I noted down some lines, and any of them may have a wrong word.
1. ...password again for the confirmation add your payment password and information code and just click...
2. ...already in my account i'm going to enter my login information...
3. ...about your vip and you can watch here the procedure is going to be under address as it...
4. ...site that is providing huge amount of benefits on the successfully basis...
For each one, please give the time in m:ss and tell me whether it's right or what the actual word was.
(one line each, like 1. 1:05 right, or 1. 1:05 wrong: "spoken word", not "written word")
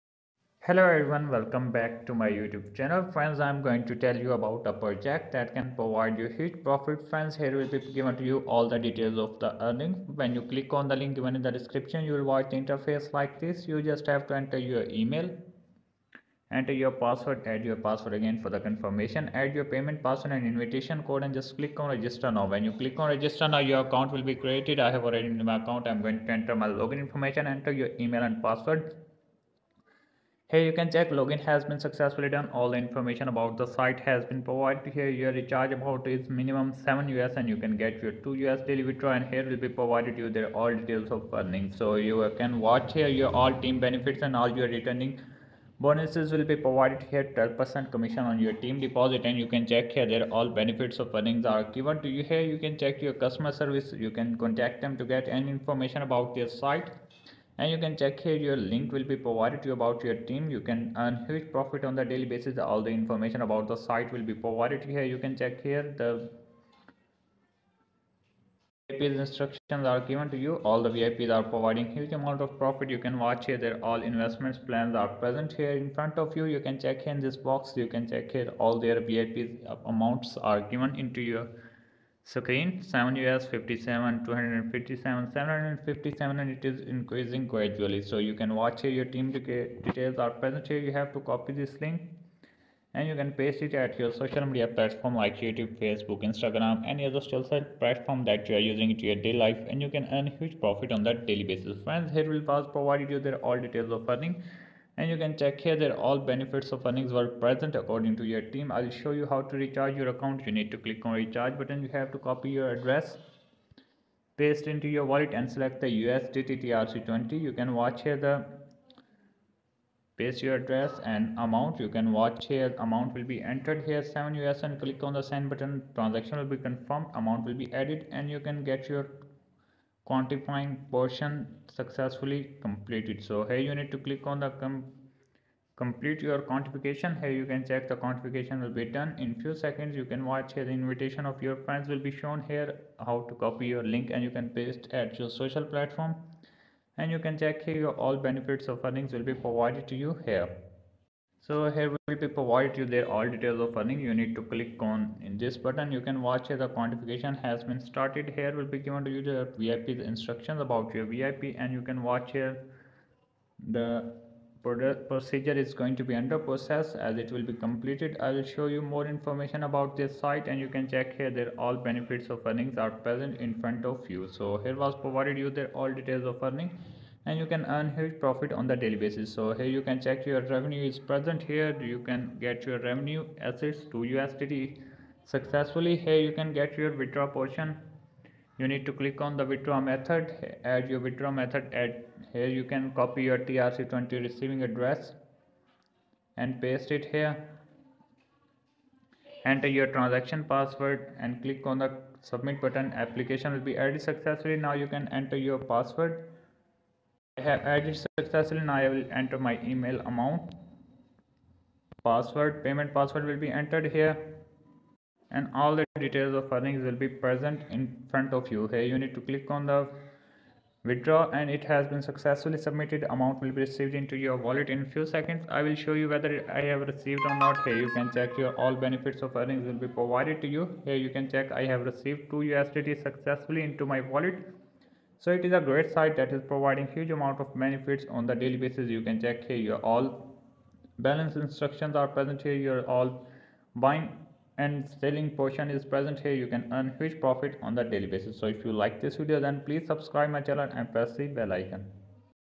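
1. 0:17 wrong: "invitation", not "information"
2. 0:25 right
3. 2:40 wrong: "process", not "address"
4. 3:55 wrong: "daily", not "successfully".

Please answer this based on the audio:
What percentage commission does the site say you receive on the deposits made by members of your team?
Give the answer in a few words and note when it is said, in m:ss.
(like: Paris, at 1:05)
12%, at 0:47.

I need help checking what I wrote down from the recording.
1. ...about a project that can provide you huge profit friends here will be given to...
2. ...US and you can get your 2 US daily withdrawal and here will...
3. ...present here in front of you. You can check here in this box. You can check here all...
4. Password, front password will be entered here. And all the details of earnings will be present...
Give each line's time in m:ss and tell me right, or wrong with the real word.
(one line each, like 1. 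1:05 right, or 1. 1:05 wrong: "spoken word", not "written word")
1. 0:04 right
2. 0:37 right
3. 1:15 right
4. 3:32 wrong: "payment", not "front".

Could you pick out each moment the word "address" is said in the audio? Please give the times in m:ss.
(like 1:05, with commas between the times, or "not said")
1:52, 2:00, 3:14.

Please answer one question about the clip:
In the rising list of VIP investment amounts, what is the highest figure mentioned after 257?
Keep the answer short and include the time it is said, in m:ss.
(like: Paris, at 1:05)
757, at 1:25.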